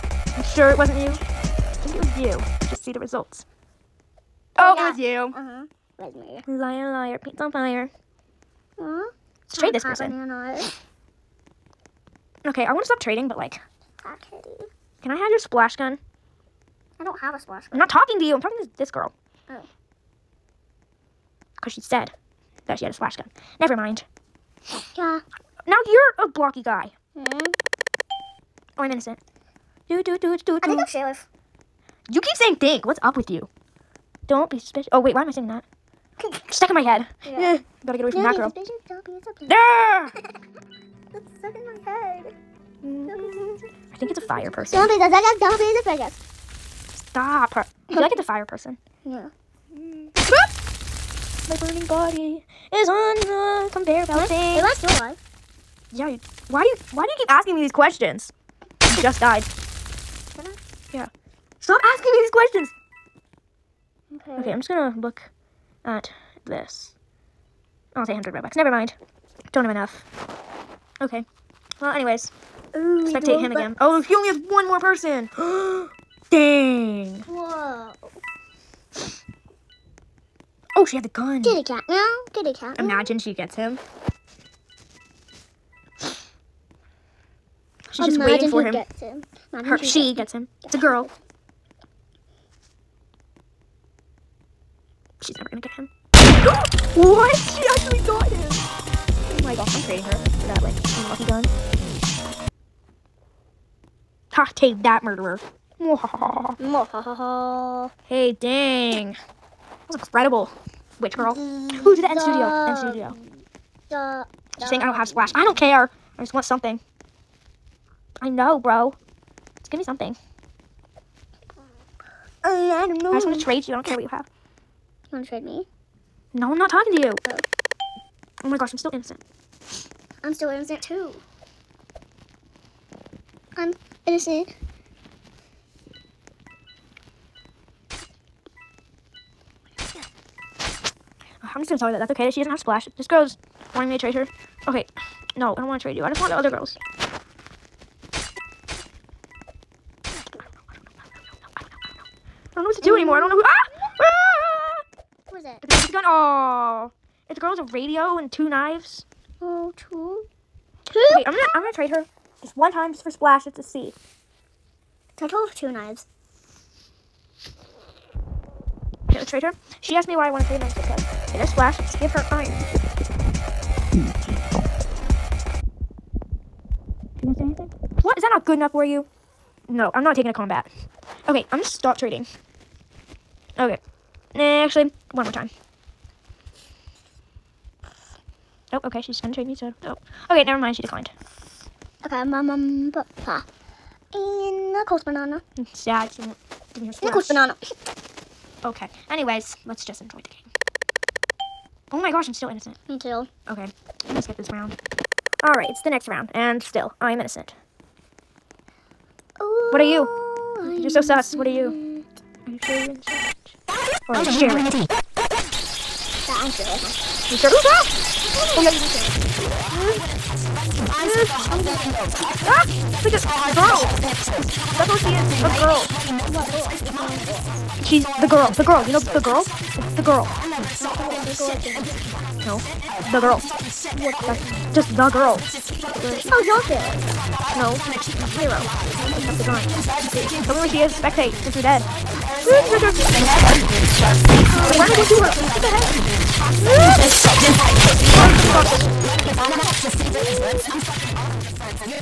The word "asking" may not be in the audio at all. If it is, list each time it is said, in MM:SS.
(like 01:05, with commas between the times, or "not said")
00:57, 01:01.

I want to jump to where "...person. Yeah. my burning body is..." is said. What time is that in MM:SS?
00:48.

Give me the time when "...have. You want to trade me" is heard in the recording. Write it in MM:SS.
02:04.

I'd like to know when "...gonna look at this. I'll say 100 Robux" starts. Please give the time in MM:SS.
01:04.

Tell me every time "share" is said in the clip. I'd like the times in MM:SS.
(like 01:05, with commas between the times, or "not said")
03:34.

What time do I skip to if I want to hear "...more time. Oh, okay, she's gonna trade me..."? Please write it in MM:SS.
03:05.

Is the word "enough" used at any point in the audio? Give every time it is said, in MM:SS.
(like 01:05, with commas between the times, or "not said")
01:09, 02:58.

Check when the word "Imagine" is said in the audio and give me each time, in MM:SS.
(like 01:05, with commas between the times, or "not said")
01:22, 01:27.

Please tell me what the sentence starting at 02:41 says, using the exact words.
I'm gonna I'm gonna trade her just one time just for splash just to see.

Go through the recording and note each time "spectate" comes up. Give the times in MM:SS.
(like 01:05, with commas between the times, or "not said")
01:13, 04:00.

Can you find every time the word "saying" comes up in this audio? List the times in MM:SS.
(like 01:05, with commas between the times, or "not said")
00:32, 01:54.